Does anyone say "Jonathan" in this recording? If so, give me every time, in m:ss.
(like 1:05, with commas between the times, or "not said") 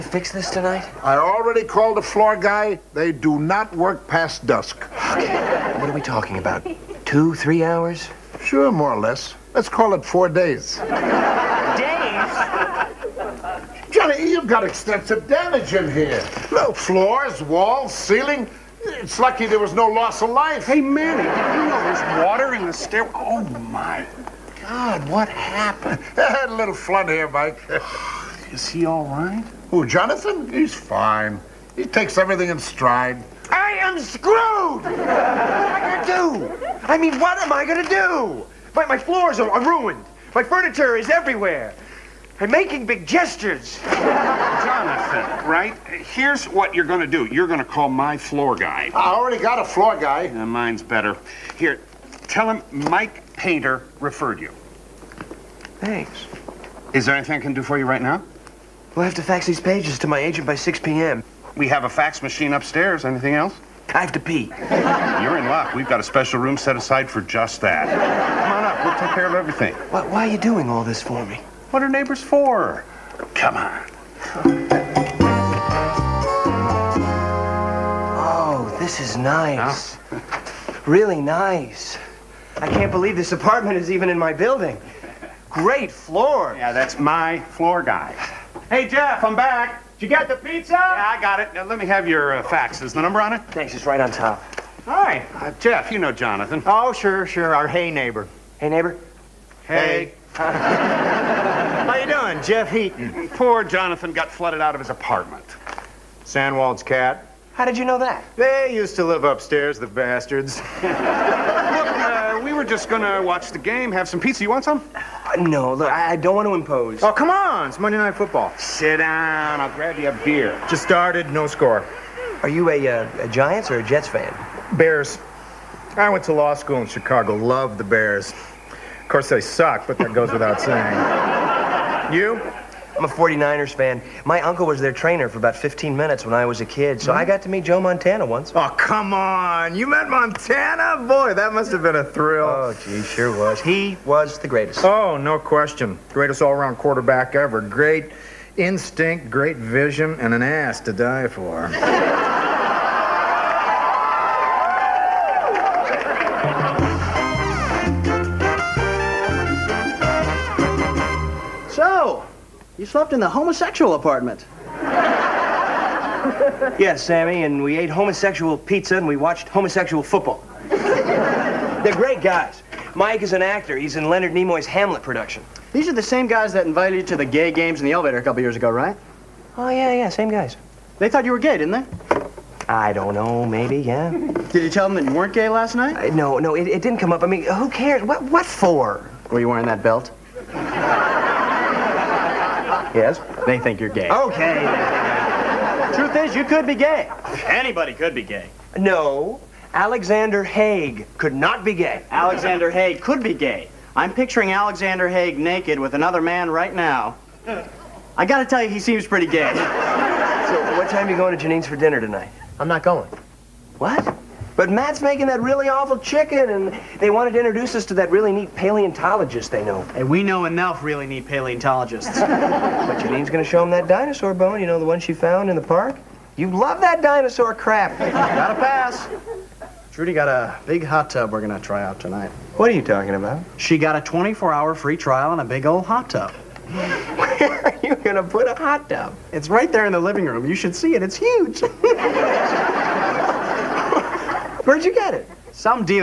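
0:29, 0:43, 1:36, 1:43.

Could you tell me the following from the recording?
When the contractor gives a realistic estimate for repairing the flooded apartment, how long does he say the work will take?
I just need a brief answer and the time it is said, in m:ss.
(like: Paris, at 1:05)
4 days, at 0:10.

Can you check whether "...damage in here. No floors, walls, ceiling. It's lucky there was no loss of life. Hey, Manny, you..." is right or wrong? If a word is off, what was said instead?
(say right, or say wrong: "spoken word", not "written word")
right.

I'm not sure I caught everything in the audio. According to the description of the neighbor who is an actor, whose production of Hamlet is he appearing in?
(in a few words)
Leonard Nimoy.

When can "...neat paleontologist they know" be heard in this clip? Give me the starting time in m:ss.
3:38.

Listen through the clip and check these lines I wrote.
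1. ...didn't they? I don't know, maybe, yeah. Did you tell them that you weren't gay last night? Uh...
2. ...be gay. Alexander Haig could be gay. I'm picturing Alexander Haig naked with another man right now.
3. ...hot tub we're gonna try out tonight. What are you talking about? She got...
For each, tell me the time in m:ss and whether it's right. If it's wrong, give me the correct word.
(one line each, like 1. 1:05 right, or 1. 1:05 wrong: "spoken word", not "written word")
1. 3:01 right
2. 3:21 right
3. 3:50 right.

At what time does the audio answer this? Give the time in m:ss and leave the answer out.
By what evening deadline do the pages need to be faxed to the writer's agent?
1:00.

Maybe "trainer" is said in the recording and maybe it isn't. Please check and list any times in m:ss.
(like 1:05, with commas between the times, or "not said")
2:14.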